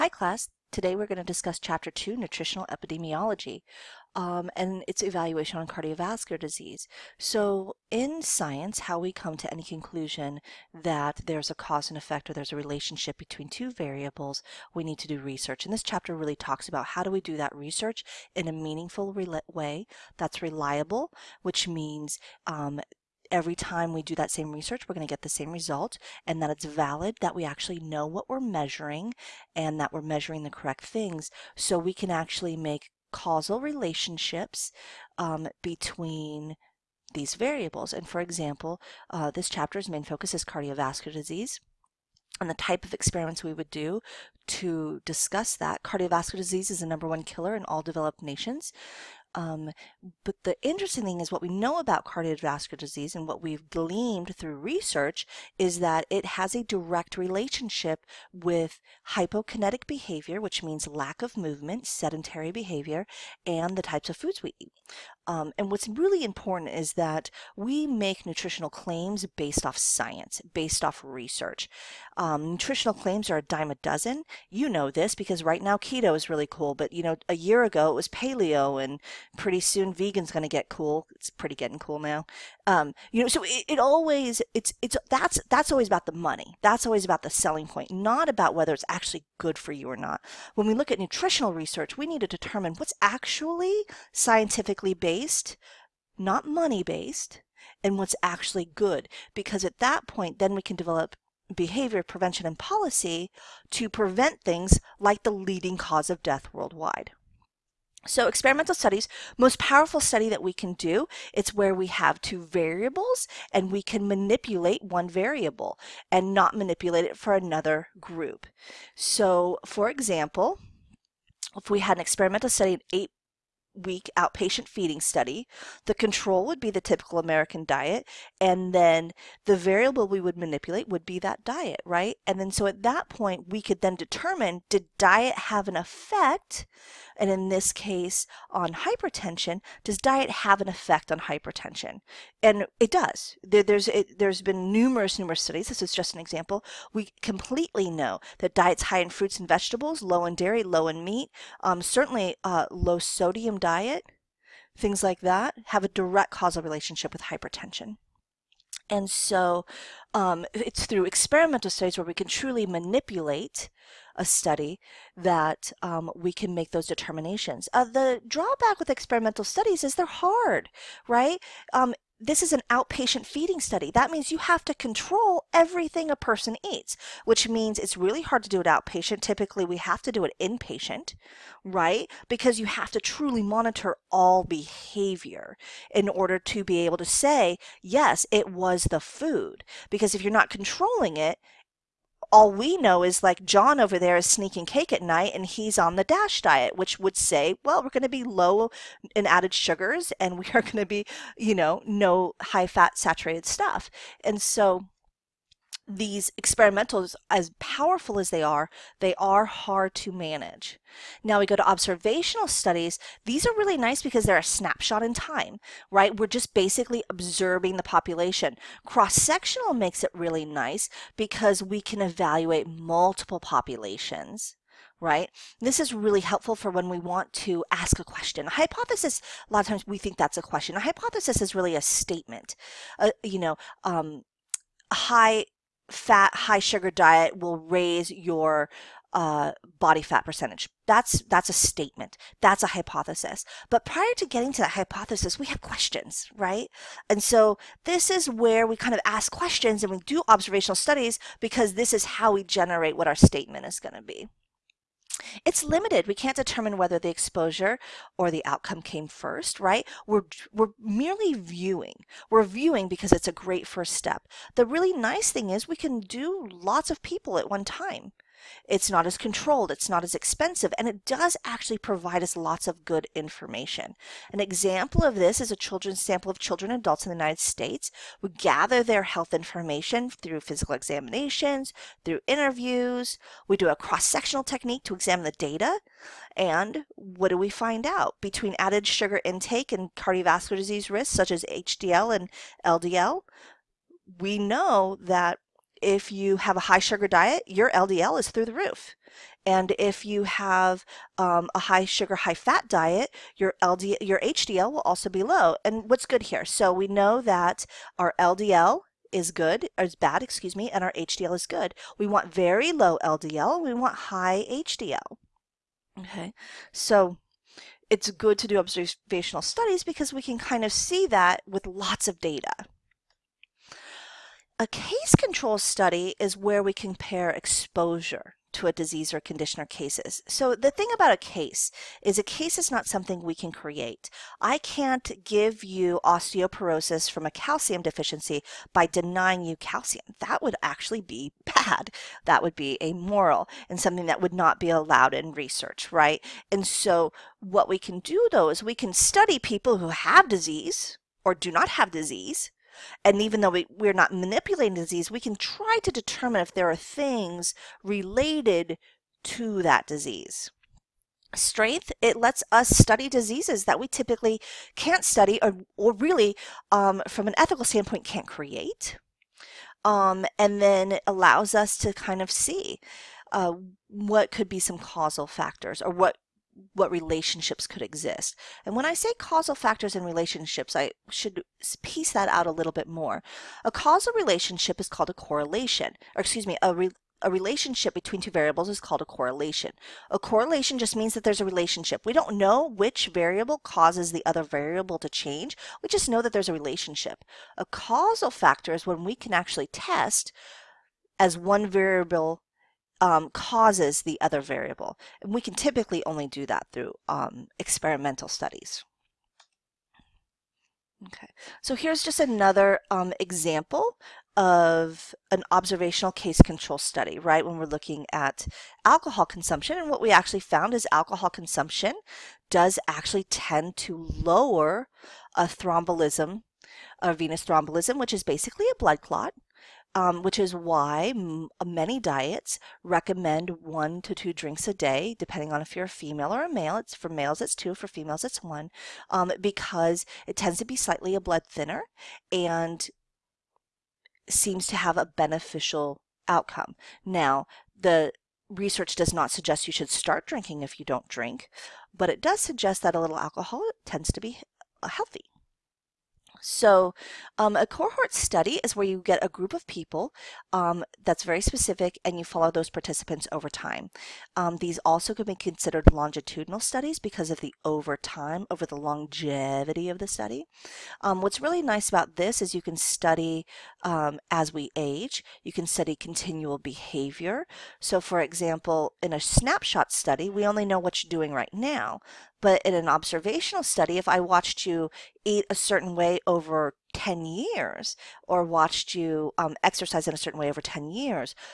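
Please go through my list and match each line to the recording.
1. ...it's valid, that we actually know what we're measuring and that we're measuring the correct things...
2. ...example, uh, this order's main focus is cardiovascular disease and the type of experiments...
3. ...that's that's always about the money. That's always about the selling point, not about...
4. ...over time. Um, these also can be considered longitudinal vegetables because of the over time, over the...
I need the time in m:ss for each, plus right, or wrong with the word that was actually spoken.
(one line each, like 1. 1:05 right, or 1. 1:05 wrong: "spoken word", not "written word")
1. 0:26 right
2. 0:38 wrong: "chapter", not "order"
3. 1:25 right
4. 7:43 wrong: "studies", not "vegetables".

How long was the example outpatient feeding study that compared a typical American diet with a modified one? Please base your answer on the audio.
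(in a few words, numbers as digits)
eight week.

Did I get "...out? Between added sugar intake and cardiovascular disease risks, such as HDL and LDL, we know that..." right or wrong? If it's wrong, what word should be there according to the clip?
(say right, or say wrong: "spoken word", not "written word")
right.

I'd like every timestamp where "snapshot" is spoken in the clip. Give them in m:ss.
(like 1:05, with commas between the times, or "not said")
3:34, 7:59.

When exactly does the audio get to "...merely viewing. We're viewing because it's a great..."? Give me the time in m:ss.
4:20.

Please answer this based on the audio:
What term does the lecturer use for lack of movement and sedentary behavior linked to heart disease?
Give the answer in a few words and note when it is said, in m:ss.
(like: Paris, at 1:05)
hypokinetic, at 0:59.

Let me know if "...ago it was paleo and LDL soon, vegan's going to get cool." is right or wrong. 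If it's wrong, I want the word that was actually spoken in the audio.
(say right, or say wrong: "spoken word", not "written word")
wrong: "Pretty", not "LDL".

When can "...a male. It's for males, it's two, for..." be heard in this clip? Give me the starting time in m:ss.
7:16.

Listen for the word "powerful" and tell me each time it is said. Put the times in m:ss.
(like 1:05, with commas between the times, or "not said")
1:49, 3:27.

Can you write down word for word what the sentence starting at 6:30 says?
A correlation just means that there's a relationship.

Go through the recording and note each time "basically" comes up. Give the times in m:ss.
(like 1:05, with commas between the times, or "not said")
3:36, 7:08.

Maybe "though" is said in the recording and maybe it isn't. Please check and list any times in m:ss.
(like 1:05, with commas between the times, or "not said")
5:48, 5:53.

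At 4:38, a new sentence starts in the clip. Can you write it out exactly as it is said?
We gather their health information through physical examinations, through interviews.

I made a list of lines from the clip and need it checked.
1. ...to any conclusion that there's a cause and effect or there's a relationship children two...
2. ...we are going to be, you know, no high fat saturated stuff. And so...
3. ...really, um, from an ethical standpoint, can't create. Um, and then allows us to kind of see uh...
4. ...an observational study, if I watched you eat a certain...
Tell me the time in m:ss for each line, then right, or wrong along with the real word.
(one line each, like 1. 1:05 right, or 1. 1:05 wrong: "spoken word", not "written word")
1. 0:09 wrong: "between", not "children"
2. 3:20 right
3. 6:05 right
4. 8:02 right.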